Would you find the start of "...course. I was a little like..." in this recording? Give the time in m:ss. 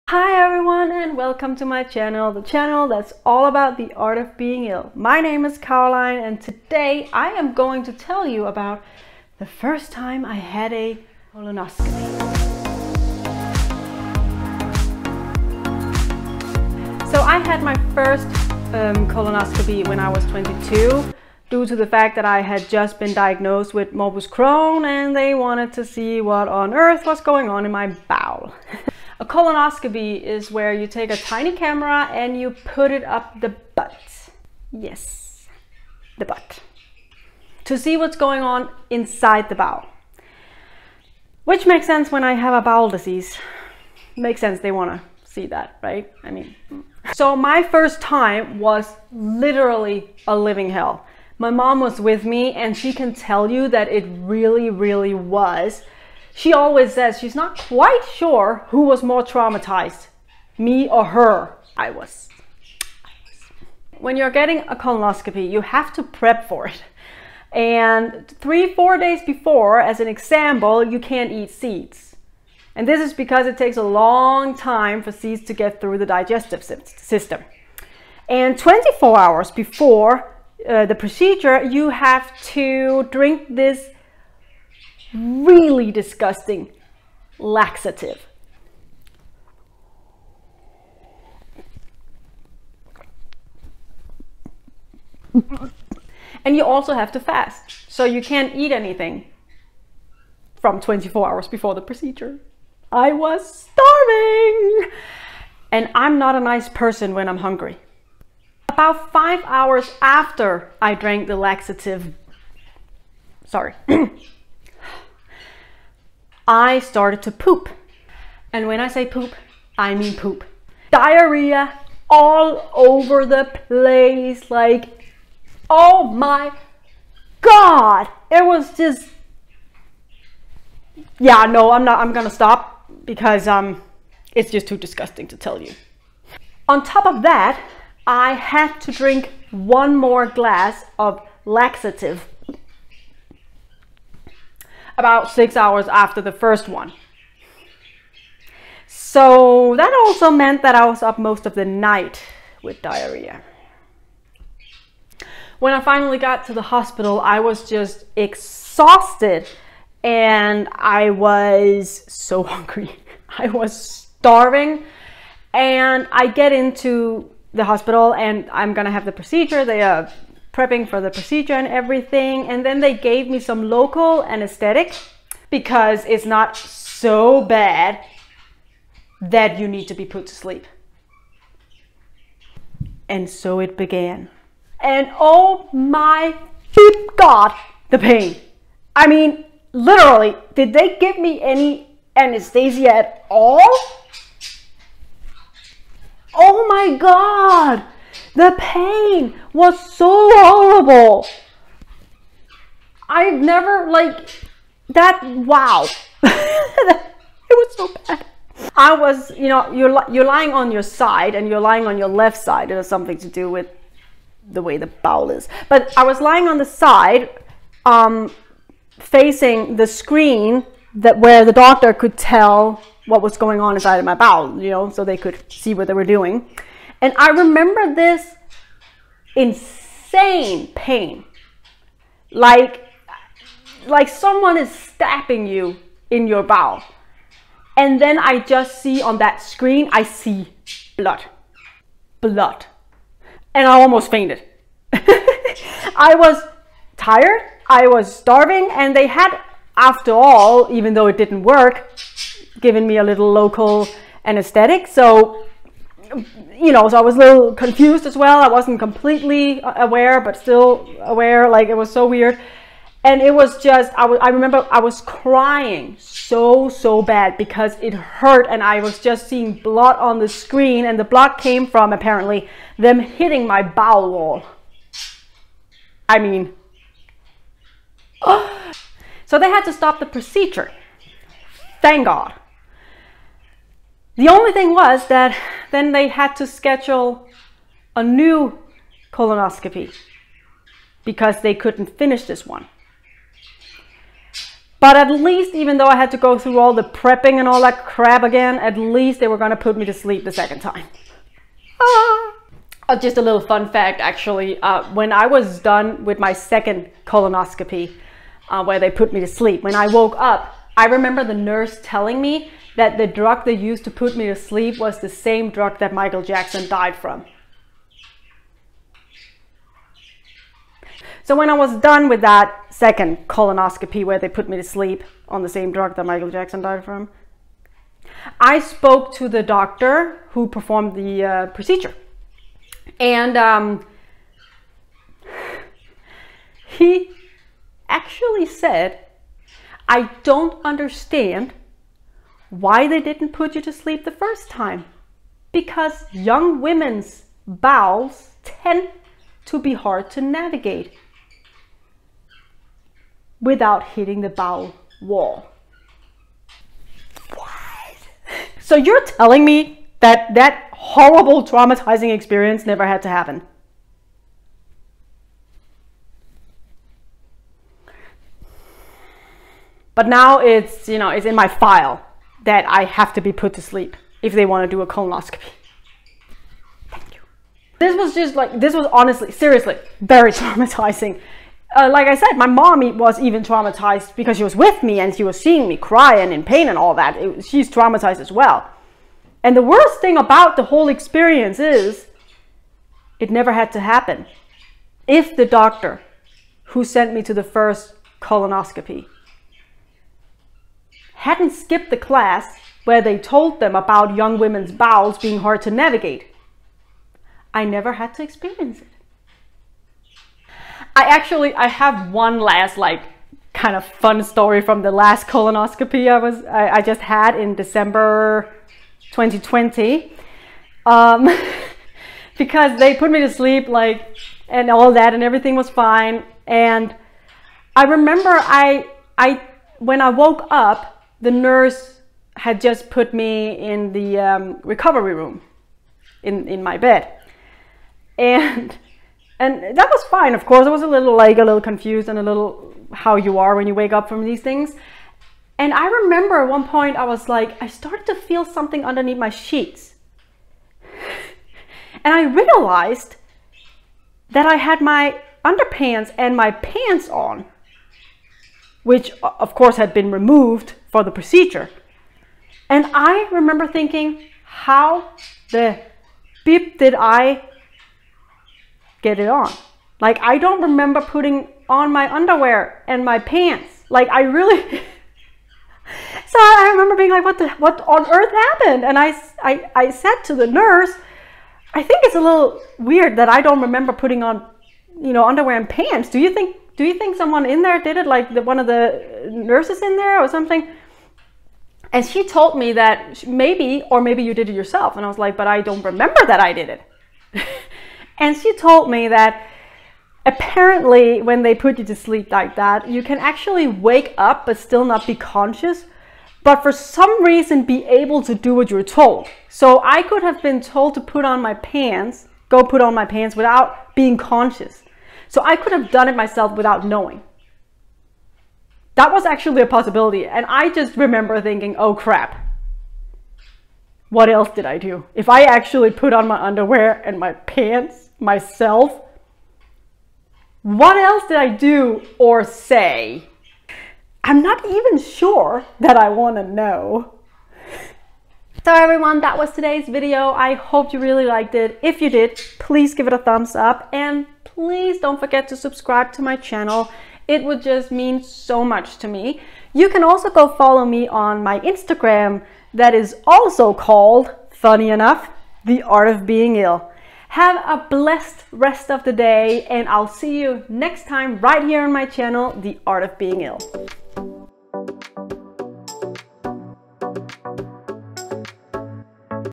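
7:20.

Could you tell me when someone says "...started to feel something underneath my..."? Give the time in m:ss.
7:27.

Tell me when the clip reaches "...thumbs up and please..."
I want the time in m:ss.
9:03.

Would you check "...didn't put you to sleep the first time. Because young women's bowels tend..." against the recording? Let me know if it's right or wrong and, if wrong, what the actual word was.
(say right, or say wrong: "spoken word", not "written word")
right.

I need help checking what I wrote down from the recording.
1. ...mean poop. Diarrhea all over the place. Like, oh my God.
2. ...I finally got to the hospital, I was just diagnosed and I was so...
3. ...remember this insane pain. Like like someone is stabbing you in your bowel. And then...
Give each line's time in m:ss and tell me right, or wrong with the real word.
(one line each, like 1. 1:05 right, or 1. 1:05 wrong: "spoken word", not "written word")
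1. 1:59 right
2. 2:35 wrong: "exhausted", not "diagnosed"
3. 3:47 right.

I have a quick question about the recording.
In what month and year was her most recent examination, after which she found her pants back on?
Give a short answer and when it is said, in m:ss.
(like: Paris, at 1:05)
December 2020, at 6:57.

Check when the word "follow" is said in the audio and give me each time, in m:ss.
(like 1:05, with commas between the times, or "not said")
9:10.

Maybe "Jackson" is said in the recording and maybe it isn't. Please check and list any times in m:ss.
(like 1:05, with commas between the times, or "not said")
5:16, 5:26.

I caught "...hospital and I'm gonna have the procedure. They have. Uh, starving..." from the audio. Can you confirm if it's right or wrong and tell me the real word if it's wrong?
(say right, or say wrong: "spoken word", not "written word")
wrong: "prepping", not "starving".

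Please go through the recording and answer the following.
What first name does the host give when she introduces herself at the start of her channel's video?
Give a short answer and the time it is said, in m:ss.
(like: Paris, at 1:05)
Caroline, at 0:05.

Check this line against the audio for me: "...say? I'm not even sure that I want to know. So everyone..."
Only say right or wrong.
right.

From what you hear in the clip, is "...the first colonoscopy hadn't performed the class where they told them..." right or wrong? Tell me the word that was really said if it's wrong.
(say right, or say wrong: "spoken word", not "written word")
wrong: "skipped", not "performed".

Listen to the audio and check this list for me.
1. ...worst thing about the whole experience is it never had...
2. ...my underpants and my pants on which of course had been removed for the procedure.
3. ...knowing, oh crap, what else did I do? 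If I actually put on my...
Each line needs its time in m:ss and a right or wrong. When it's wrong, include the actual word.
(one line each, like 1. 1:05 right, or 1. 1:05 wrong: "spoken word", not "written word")
1. 6:29 right
2. 7:34 right
3. 8:41 wrong: "thinking", not "knowing".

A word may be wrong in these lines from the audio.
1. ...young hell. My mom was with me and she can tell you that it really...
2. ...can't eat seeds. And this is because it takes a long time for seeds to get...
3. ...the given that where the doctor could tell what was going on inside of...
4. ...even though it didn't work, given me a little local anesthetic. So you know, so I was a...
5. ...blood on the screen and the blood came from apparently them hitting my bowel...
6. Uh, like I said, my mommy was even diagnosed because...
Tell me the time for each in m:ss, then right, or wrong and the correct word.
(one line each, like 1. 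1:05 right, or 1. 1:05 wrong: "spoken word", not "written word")
1. 0:50 wrong: "living", not "young"
2. 1:10 right
3. 3:39 wrong: "screen", not "given"
4. 4:10 right
5. 4:29 right
6. 6:21 wrong: "traumatized", not "diagnosed".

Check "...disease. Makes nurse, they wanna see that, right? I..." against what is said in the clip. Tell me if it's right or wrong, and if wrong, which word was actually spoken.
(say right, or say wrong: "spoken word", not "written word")
wrong: "sense", not "nurse".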